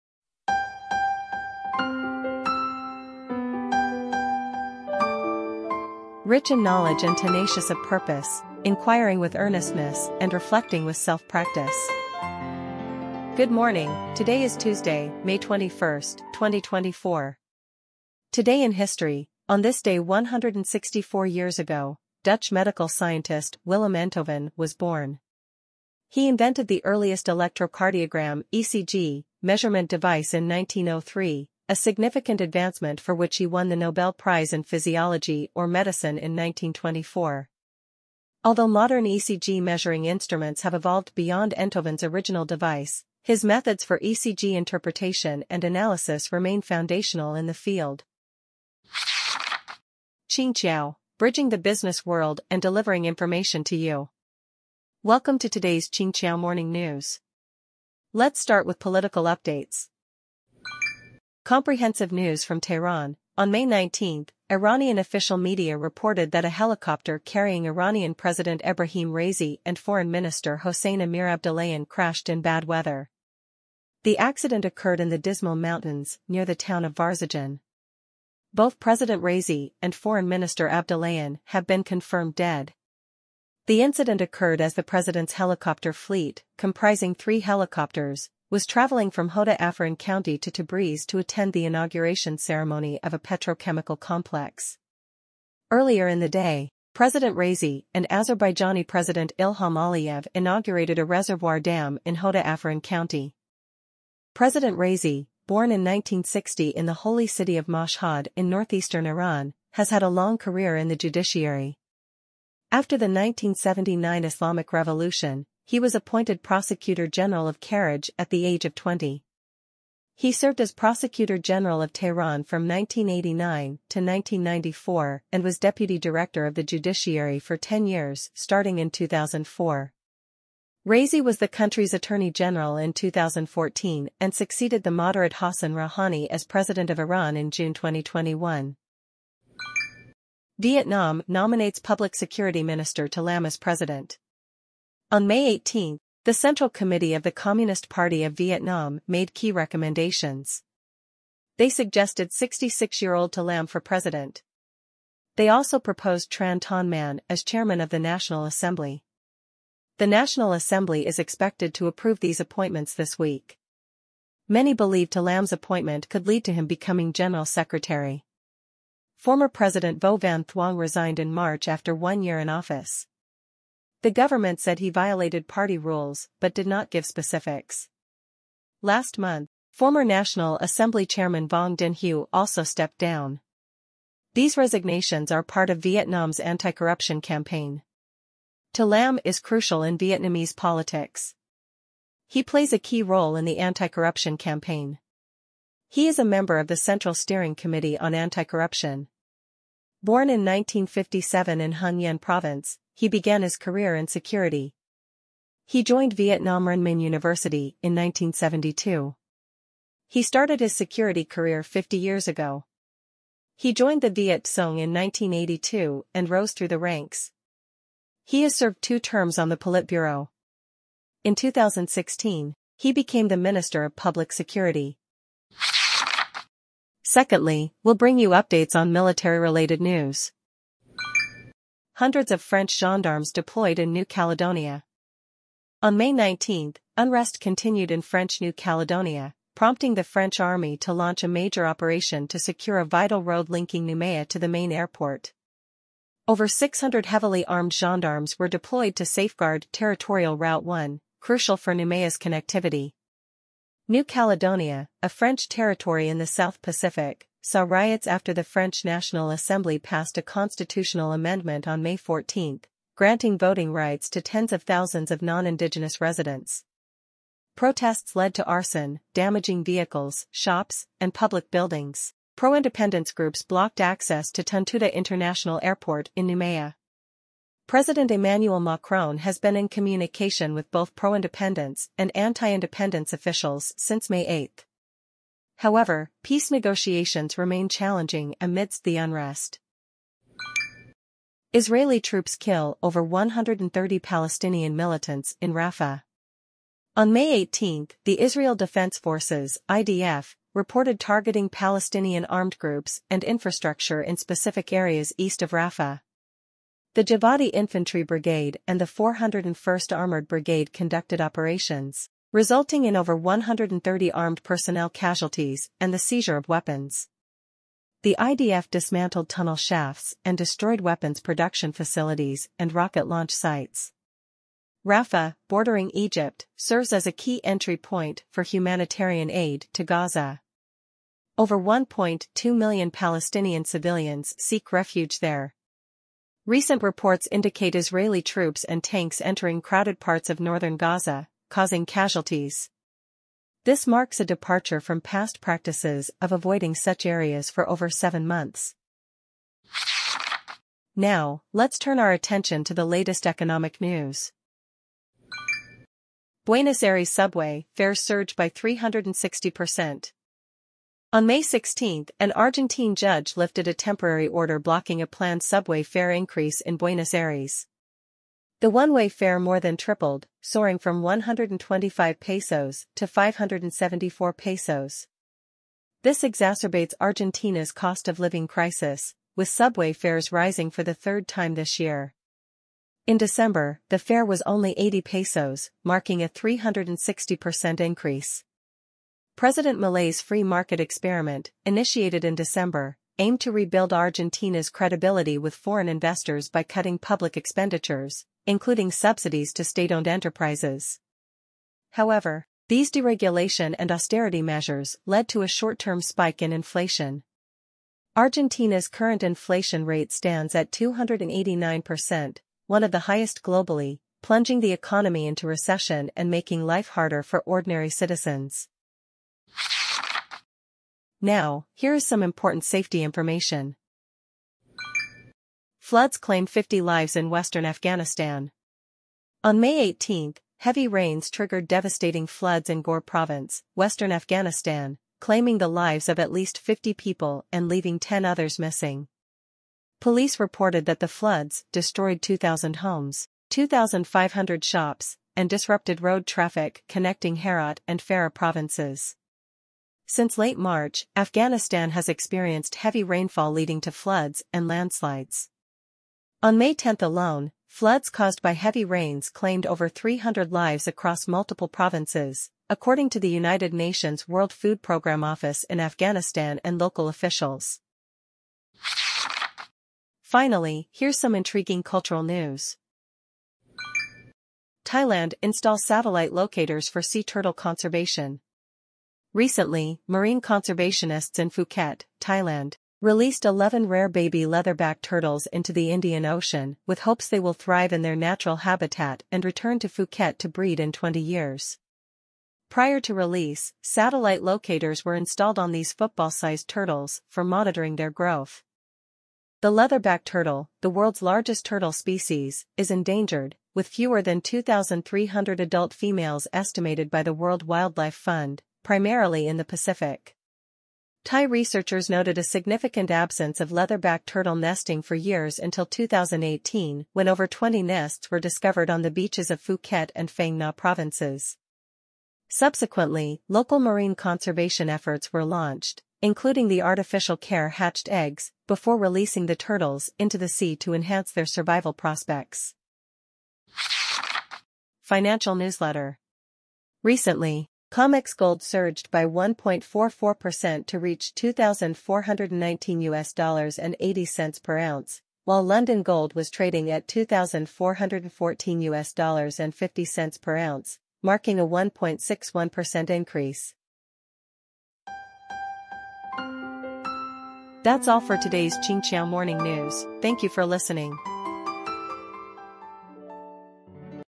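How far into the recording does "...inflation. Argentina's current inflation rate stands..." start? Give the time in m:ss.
6:46.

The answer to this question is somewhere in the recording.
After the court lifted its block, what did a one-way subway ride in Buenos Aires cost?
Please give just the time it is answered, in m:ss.
6:13.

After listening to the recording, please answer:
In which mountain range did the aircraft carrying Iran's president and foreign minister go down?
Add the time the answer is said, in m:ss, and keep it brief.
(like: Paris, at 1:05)
Dizmar Mountains, at 1:15.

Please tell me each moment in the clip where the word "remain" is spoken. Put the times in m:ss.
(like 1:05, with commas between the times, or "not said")
0:46, 4:47.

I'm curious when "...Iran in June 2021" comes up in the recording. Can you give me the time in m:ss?
2:16.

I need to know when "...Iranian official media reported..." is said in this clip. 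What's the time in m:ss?
1:04.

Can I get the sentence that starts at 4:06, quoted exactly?
Over 600 heavily armed gendarmes were deployed to safeguard Territorial Route 1, crucial for Noumea's connectivity.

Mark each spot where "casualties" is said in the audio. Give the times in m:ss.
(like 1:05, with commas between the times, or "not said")
5:14, 5:41.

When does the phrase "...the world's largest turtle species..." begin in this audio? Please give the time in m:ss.
8:20.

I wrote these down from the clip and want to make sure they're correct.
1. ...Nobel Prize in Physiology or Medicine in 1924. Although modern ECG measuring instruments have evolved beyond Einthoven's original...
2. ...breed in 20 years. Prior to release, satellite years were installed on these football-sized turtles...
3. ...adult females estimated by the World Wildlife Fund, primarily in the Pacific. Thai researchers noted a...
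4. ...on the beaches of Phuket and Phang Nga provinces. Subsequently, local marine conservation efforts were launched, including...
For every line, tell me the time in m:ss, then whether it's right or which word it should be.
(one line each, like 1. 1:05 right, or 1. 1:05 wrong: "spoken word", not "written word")
1. 0:33 right
2. 8:10 wrong: "locators", not "years"
3. 8:25 right
4. 8:38 right.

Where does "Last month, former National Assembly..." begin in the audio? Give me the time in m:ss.
2:58.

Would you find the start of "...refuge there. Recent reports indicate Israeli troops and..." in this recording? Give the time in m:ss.
5:34.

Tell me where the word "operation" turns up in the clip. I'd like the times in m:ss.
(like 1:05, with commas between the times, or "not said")
4:01, 5:11.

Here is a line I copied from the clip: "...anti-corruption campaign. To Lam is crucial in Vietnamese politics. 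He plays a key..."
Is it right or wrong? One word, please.
right.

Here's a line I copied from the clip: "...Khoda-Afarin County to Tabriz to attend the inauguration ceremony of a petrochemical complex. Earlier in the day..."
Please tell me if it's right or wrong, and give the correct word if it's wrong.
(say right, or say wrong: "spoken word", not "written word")
right.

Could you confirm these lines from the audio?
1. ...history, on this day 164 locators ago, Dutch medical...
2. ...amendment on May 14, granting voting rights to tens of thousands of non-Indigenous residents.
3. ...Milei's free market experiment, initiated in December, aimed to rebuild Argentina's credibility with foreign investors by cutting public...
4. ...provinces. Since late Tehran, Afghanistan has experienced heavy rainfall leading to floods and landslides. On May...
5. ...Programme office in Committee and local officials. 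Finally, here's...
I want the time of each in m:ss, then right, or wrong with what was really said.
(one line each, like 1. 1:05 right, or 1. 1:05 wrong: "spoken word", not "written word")
1. 0:18 wrong: "years", not "locators"
2. 4:21 right
3. 6:29 right
4. 7:28 wrong: "March", not "Tehran"
5. 7:44 wrong: "Afghanistan", not "Committee".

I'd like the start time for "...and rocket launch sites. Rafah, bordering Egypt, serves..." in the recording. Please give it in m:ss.
5:22.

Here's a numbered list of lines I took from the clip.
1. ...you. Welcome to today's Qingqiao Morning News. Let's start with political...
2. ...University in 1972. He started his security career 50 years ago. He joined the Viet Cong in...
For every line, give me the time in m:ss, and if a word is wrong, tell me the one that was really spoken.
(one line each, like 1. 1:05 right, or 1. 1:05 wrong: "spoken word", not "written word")
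1. 0:53 right
2. 3:27 right.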